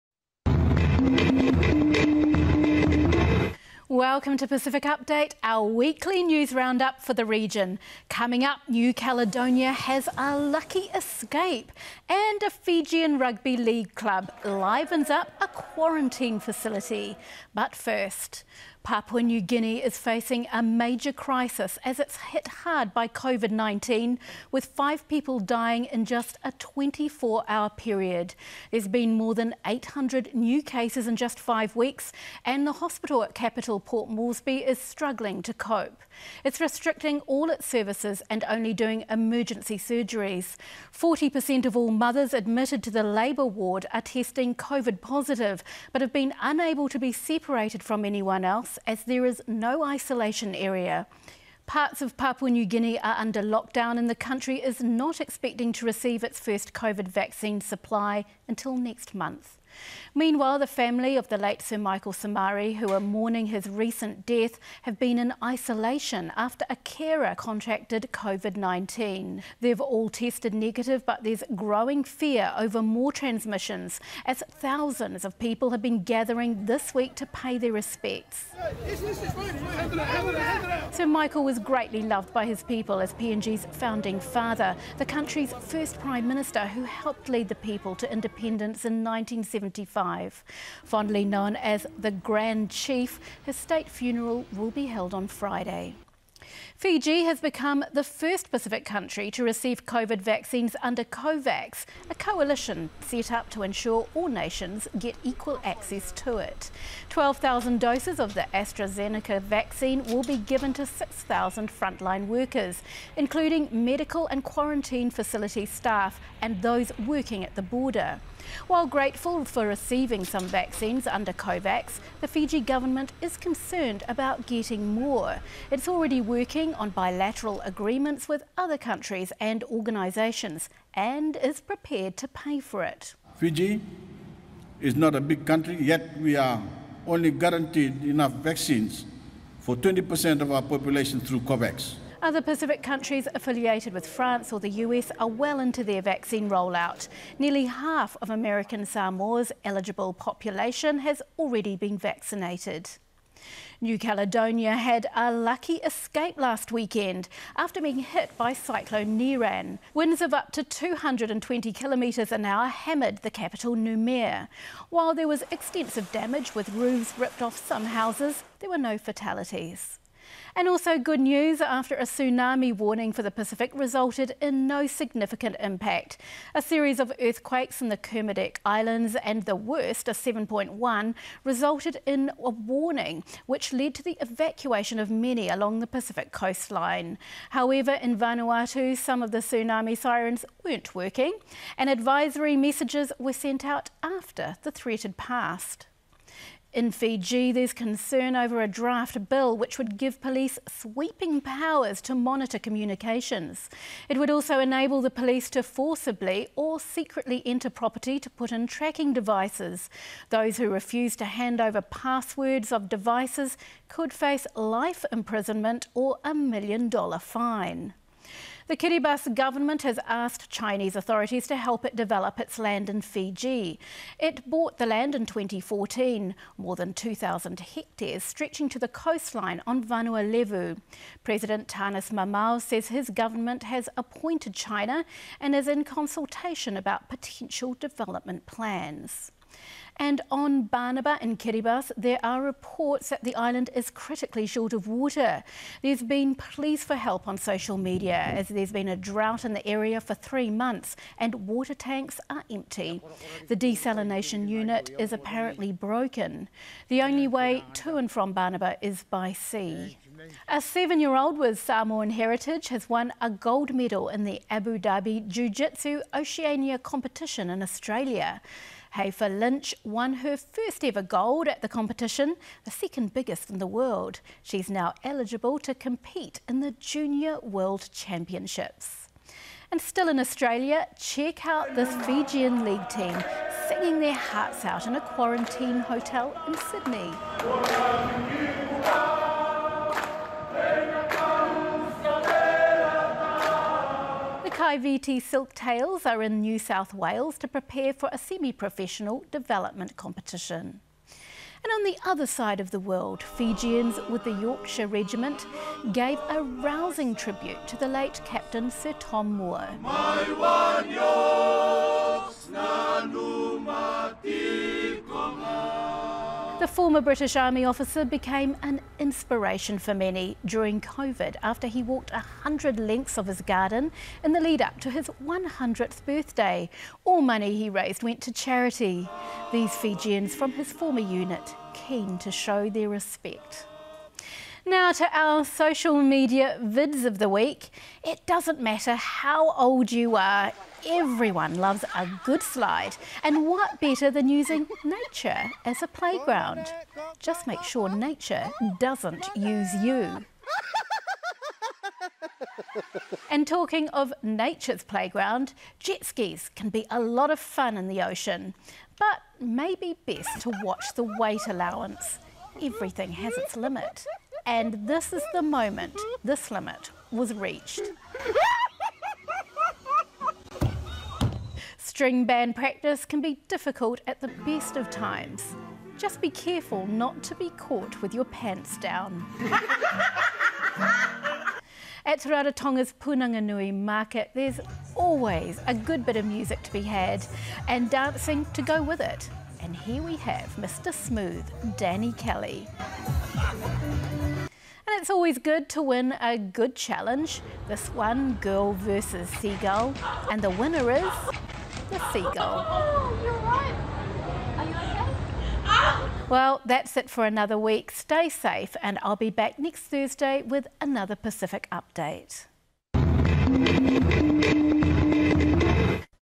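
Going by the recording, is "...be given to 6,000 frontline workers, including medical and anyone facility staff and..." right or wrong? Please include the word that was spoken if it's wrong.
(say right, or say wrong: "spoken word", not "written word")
wrong: "quarantine", not "anyone".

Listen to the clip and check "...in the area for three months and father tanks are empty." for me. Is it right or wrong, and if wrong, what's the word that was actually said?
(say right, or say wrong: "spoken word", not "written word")
wrong: "water", not "father".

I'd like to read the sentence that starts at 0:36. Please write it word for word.
It's restricting all its services and only doing emergency surgeries.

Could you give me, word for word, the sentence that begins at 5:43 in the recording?
And what better than using nature as a playground?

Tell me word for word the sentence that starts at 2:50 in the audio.
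And also good news after a tsunami warning for the Pacific resulted in no significant impact.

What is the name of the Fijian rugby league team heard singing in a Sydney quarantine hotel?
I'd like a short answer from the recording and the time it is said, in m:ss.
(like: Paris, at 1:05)
Kaiviti Silktails, at 4:54.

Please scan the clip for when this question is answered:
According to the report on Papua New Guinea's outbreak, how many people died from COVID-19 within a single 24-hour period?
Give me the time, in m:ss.
0:24.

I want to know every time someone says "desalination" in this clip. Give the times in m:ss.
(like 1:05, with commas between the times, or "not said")
4:13.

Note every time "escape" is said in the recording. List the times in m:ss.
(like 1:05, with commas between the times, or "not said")
0:10, 2:35.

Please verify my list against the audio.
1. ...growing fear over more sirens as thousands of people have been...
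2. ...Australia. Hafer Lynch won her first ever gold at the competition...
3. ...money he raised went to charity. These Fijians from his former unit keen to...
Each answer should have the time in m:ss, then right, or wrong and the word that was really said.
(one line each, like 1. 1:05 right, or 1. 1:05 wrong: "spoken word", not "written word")
1. 1:11 wrong: "transmissions", not "sirens"
2. 4:27 right
3. 5:27 right.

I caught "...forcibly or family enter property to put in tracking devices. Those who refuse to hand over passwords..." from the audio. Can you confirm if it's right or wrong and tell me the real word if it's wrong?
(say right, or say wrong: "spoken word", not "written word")
wrong: "secretly", not "family".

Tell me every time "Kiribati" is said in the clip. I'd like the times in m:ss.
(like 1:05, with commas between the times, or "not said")
3:38, 4:01.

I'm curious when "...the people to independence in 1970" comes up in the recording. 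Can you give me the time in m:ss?
1:27.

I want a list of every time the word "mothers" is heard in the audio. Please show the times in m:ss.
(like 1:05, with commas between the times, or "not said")
0:41.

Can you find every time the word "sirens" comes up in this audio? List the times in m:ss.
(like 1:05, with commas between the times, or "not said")
3:09.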